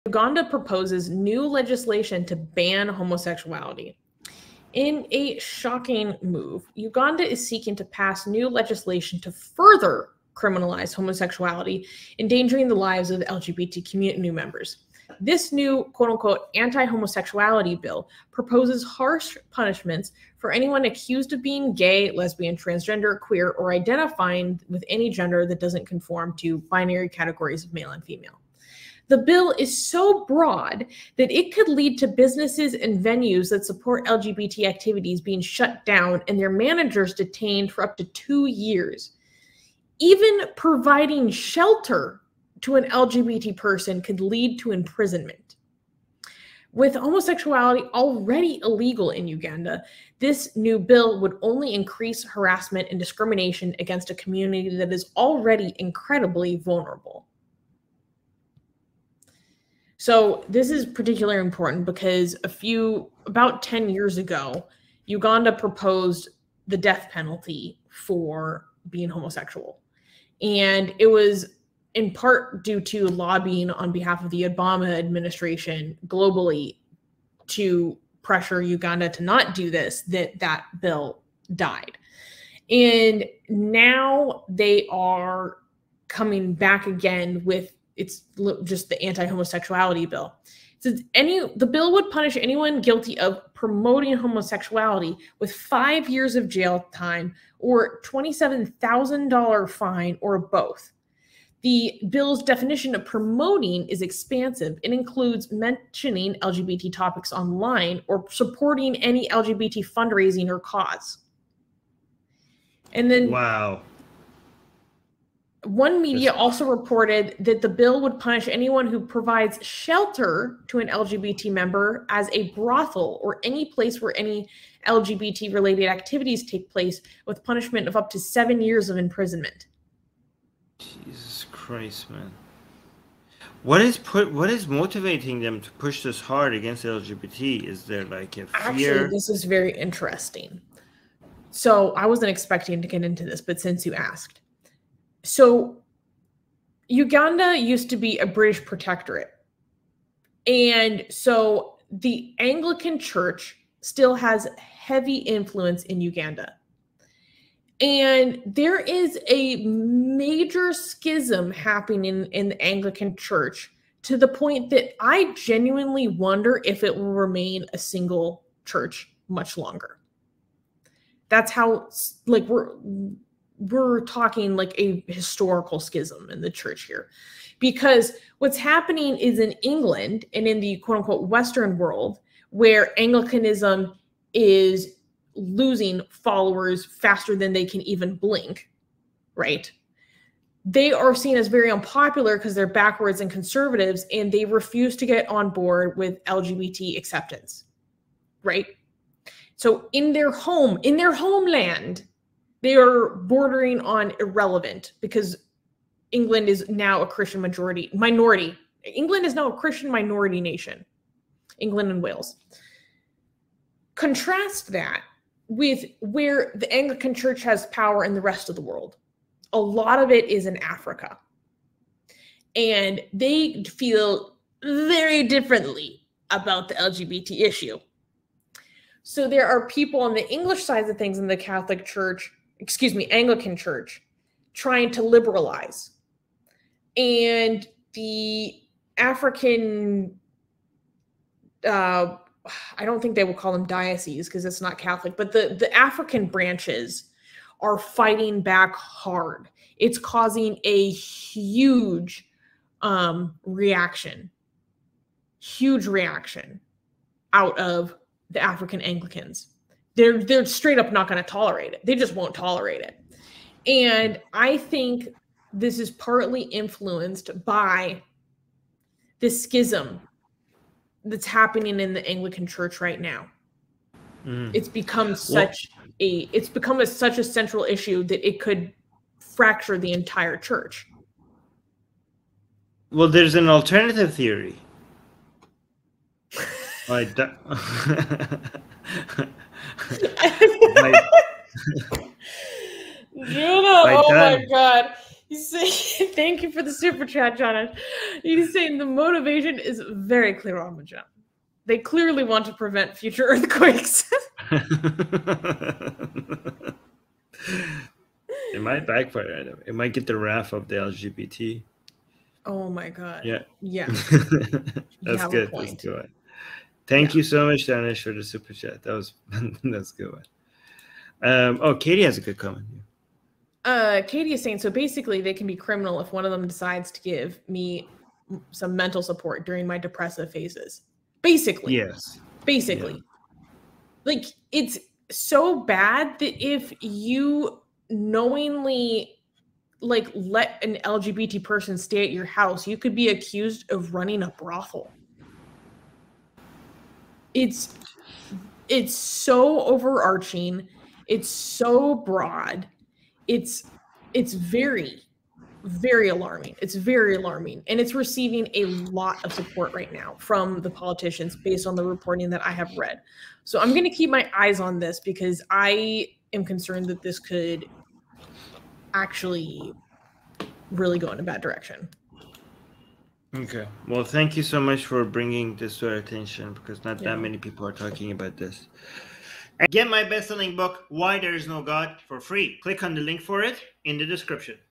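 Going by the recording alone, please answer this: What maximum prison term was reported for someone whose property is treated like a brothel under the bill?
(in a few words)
7 years.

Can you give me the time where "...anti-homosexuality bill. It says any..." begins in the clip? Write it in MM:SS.
01:29.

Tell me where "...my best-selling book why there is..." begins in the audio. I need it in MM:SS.
06:19.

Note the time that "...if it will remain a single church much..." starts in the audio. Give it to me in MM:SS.
02:46.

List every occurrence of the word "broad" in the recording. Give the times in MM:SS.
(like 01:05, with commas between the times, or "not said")
00:30, 05:51.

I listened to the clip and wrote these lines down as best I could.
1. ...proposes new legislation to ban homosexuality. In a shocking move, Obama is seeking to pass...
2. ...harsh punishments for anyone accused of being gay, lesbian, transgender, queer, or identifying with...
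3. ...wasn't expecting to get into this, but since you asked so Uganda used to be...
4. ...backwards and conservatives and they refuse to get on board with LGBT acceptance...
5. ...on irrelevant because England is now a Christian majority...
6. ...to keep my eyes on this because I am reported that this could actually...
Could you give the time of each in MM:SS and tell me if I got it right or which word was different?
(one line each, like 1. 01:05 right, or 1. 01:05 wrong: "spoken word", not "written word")
1. 00:00 wrong: "Uganda", not "Obama"
2. 00:18 right
3. 02:22 right
4. 03:12 right
5. 03:23 right
6. 06:03 wrong: "concerned", not "reported".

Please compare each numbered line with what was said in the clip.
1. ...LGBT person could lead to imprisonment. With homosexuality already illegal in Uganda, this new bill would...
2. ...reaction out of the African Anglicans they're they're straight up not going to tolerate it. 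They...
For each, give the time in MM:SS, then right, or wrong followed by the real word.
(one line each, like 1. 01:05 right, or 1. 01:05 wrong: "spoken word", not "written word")
1. 00:42 right
2. 04:15 right.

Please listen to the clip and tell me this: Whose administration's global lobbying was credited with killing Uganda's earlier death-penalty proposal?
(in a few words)
Obama administration.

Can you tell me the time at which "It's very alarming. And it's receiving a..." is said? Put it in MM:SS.
05:56.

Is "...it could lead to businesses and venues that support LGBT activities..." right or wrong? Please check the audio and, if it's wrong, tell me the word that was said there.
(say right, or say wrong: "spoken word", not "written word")
right.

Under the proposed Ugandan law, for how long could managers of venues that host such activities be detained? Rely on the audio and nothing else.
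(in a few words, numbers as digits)
2 years.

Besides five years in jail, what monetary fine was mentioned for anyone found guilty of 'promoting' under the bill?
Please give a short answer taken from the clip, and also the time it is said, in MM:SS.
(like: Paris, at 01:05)
$27,000, at 01:38.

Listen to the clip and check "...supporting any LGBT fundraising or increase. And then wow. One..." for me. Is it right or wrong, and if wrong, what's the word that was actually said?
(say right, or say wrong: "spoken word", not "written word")
wrong: "cause", not "increase".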